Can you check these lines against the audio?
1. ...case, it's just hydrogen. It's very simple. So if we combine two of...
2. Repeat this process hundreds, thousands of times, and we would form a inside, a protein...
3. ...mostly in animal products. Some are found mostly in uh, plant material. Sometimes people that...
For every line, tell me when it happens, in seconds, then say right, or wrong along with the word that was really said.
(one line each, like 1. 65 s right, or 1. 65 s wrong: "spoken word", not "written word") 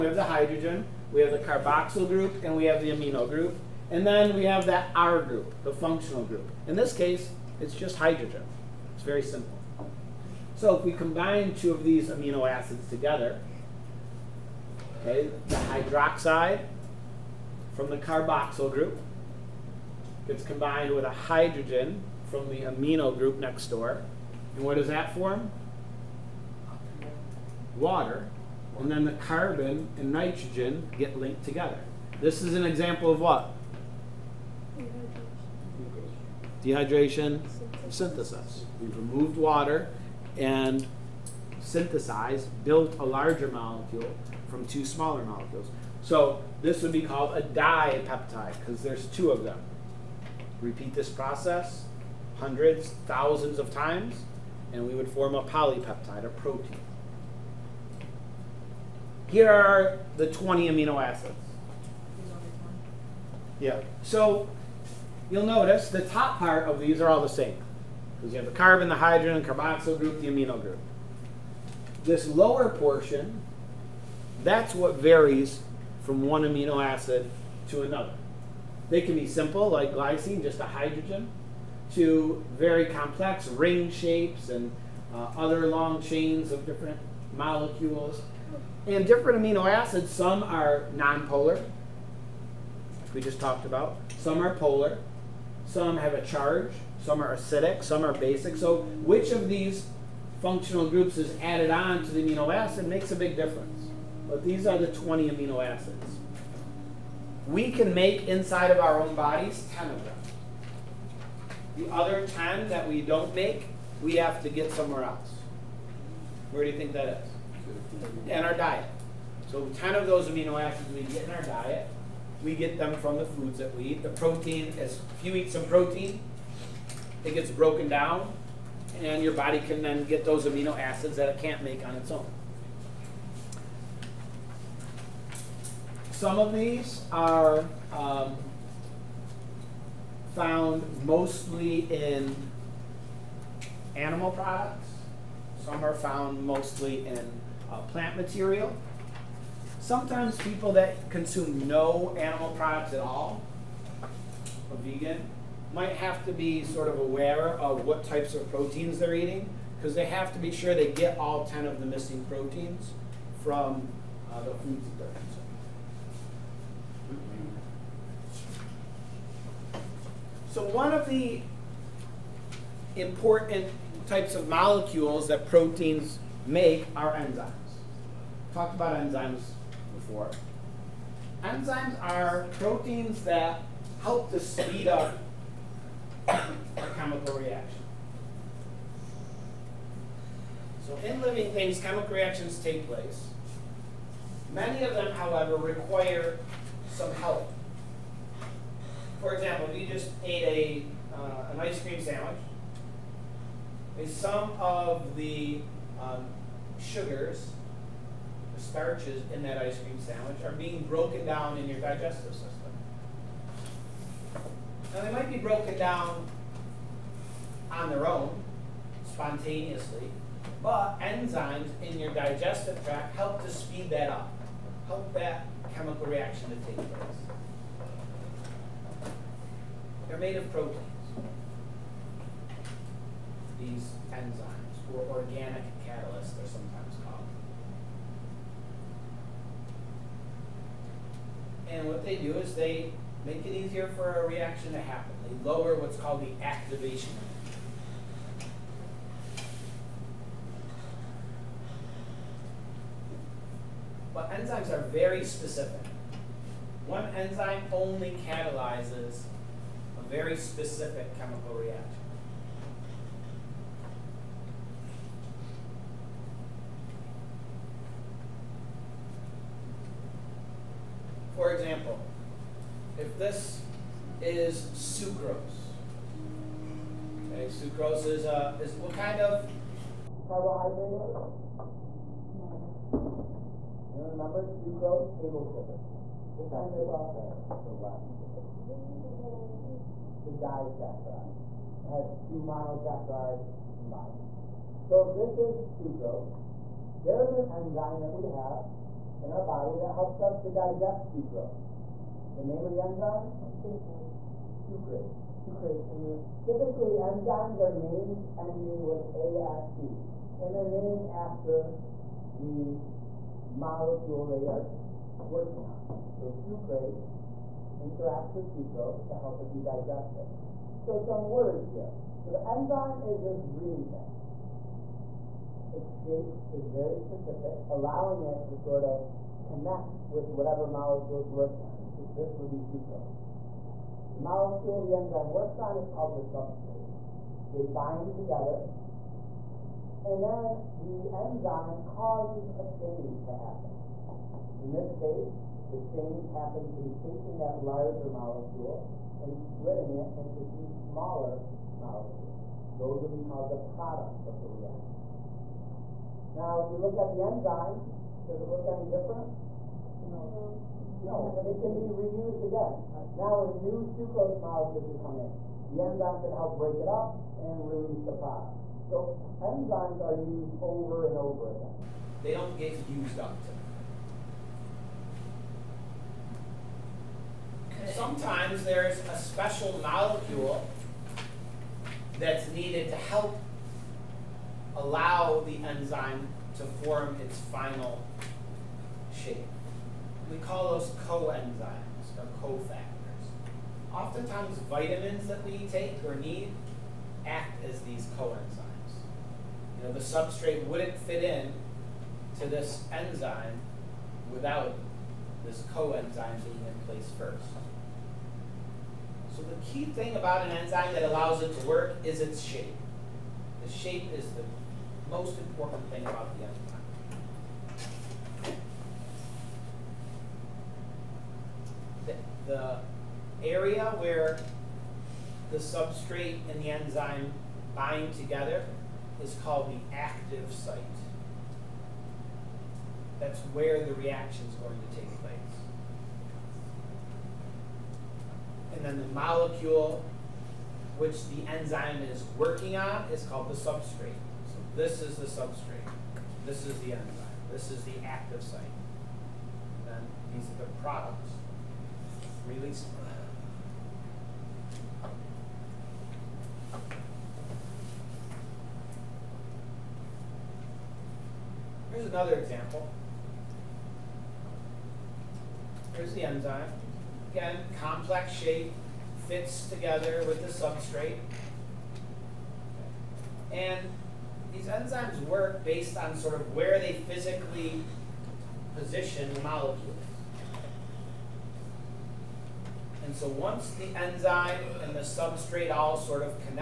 1. 6 s right
2. 50 s wrong: "polypeptide", not "inside"
3. 141 s right.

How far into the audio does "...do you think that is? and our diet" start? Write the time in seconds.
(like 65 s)
116 s.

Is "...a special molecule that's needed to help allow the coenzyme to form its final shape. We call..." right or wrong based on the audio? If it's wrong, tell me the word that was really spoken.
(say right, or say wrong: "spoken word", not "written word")
wrong: "enzyme", not "coenzyme".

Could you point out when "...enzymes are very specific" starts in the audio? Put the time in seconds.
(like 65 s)
254 s.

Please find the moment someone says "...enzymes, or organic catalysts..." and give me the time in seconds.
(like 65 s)
234 s.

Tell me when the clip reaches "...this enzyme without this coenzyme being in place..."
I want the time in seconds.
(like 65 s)
402 s.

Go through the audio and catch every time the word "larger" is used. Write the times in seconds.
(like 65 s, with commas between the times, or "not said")
43 s, 347 s.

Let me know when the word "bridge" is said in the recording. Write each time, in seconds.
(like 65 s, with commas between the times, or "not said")
not said.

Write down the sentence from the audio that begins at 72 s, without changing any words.
This lower portion, that's what varies from one amino acid to another.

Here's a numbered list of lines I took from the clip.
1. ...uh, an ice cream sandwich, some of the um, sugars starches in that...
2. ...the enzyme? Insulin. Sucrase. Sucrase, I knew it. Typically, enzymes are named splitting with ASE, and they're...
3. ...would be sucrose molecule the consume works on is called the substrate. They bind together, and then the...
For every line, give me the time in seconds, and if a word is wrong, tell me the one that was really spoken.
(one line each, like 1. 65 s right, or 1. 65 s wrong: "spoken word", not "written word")
1. 201 s right
2. 302 s wrong: "ending", not "splitting"
3. 332 s wrong: "enzyme", not "consume".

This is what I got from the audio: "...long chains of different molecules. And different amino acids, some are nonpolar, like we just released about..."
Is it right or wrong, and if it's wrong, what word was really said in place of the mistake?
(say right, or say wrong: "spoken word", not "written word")
wrong: "talked", not "released".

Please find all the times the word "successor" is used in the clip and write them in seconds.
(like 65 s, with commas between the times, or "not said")
not said.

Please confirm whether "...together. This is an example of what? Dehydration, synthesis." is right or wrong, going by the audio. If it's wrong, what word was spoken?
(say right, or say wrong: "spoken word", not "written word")
right.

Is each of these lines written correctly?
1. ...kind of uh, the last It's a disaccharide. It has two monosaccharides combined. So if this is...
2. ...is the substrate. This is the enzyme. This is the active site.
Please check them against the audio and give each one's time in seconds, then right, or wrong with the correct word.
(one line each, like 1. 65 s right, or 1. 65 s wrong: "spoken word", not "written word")
1. 286 s right
2. 445 s right.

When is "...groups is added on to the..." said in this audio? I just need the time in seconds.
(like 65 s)
100 s.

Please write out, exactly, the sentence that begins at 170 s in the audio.
So one of the important types of molecules that proteins make are enzymes talked about enzymes before.